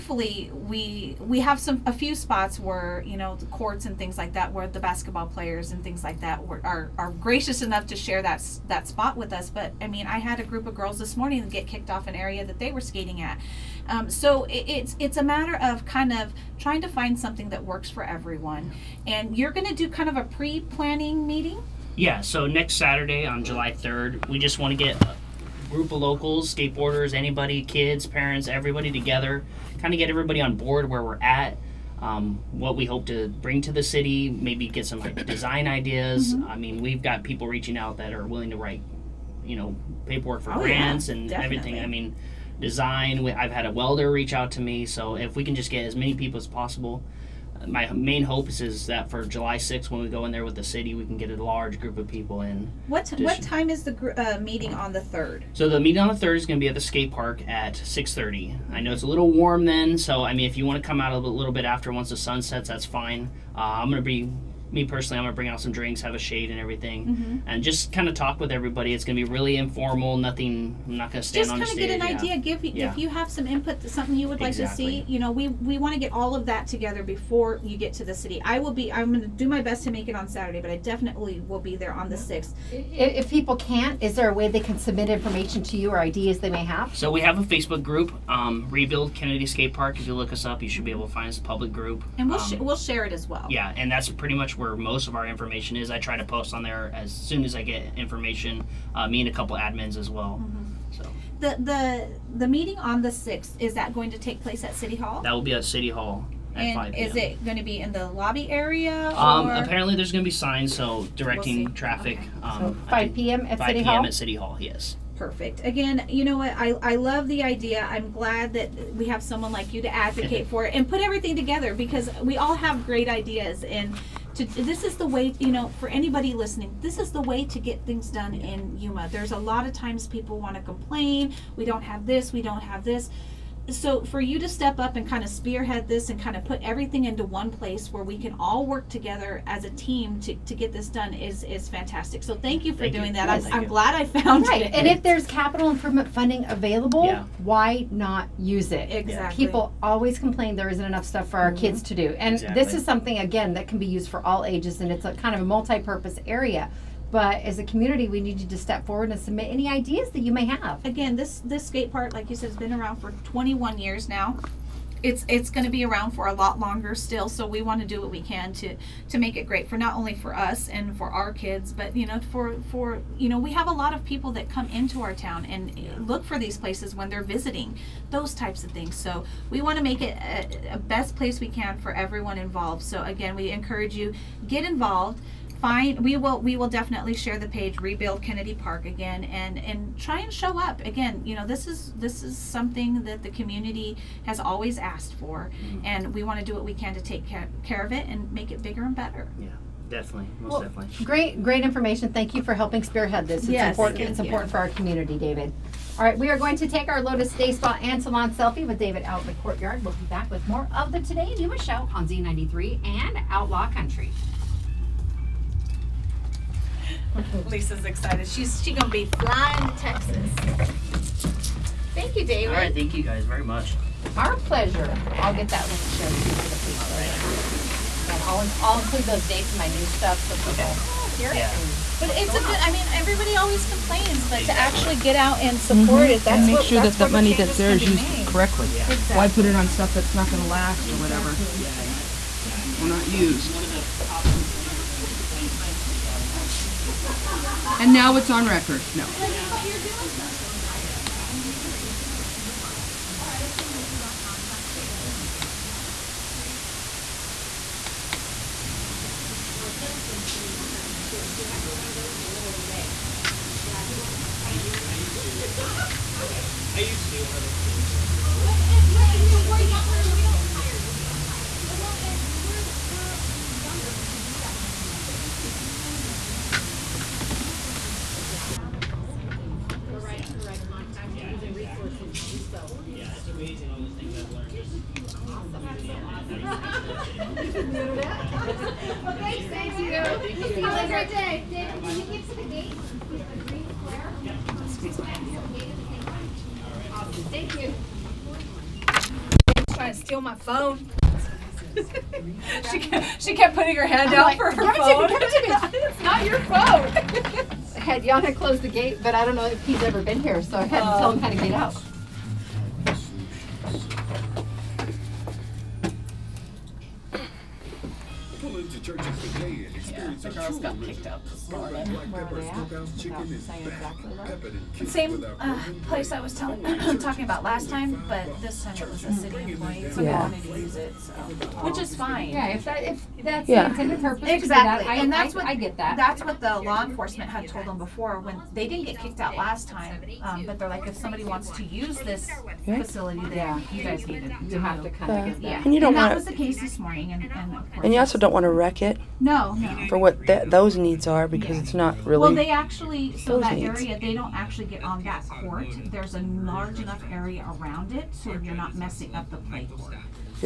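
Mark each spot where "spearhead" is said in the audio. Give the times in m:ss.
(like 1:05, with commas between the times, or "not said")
2:15, 3:22.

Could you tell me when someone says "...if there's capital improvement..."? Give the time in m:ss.
2:24.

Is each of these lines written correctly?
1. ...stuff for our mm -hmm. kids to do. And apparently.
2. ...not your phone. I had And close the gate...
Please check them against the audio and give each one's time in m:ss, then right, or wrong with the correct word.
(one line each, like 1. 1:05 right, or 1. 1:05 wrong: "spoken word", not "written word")
1. 2:31 wrong: "exactly", not "apparently"
2. 5:06 wrong: "Yana", not "And".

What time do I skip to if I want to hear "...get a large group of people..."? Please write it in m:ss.
0:51.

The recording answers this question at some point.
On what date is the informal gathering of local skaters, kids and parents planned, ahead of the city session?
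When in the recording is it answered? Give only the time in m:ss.
0:23.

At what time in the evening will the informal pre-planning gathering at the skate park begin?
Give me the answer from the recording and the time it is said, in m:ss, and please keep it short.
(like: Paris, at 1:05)
6:30, at 0:57.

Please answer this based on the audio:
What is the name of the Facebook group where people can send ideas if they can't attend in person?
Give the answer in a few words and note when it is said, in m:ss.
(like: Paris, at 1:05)
Rebuild Kennedy Skate Park, at 1:28.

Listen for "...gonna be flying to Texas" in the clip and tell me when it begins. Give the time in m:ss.
3:38.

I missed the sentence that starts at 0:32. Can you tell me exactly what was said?
Um, what we hope to bring to the city, maybe get some like, design ideas.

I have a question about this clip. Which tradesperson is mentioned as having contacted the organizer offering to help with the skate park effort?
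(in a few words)
A welder.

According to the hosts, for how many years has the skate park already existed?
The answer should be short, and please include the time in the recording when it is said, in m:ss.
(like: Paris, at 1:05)
21 years, at 2:43.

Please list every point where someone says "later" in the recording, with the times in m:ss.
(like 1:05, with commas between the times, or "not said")
3:46.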